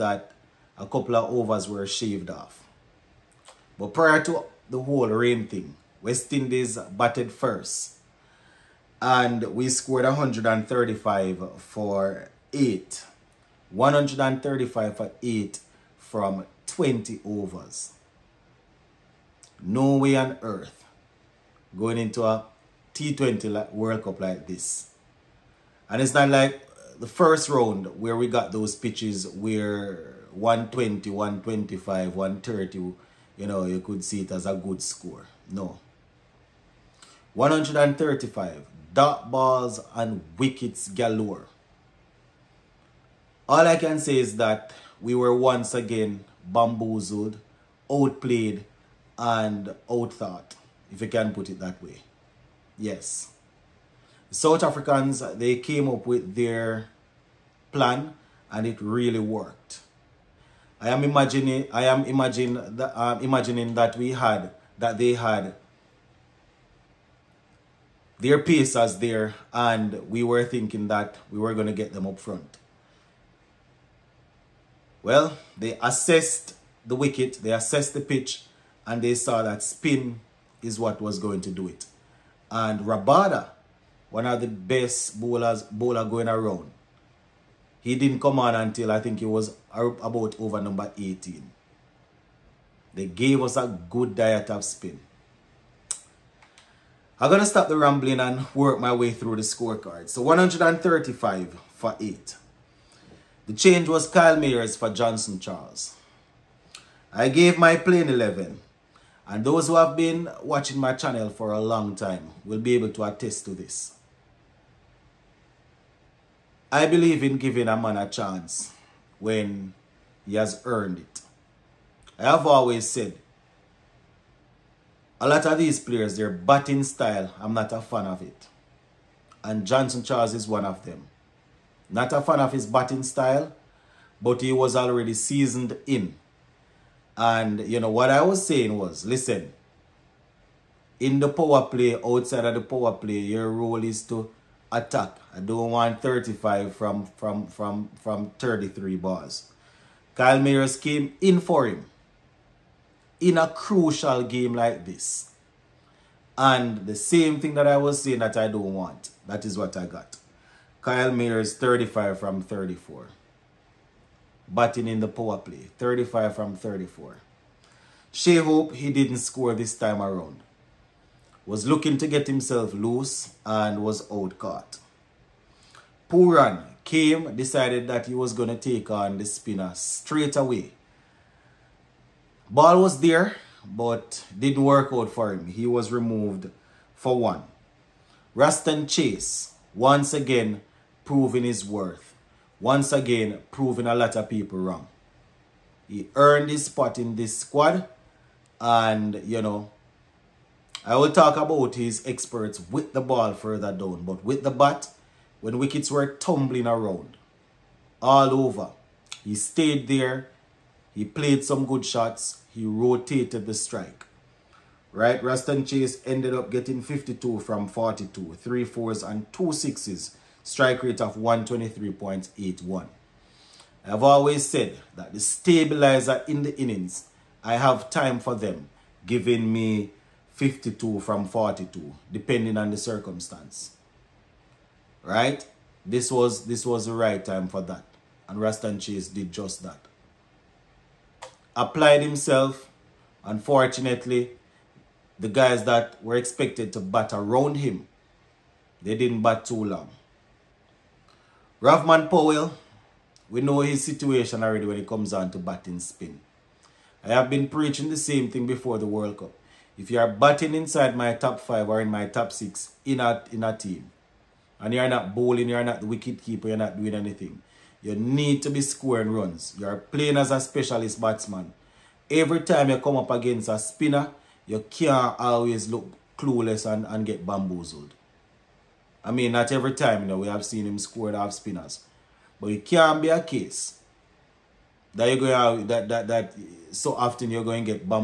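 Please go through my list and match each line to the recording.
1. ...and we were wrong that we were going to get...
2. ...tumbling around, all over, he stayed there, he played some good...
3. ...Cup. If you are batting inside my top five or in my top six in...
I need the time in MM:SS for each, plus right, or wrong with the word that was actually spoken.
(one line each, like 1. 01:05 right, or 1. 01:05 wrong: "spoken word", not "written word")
1. 01:09 wrong: "thinking", not "wrong"
2. 03:26 right
3. 04:19 right.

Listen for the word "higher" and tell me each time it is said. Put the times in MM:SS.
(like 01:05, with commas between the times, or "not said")
not said.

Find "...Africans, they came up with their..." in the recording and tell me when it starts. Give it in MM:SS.
00:54.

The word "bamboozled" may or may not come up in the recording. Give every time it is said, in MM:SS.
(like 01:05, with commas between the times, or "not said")
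00:46, 04:37.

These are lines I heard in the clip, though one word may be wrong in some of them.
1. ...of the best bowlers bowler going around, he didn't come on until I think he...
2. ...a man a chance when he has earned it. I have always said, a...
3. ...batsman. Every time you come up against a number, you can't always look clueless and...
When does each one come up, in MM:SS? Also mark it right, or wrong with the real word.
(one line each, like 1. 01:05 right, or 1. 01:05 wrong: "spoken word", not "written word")
1. 01:24 right
2. 01:57 right
3. 04:31 wrong: "spinner", not "number".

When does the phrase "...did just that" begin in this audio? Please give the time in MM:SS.
03:59.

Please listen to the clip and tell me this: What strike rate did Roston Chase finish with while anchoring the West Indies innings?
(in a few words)
123.81.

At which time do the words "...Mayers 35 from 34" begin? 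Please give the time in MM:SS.
02:41.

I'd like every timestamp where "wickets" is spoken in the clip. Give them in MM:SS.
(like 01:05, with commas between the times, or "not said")
00:40, 01:16, 03:25, 04:25.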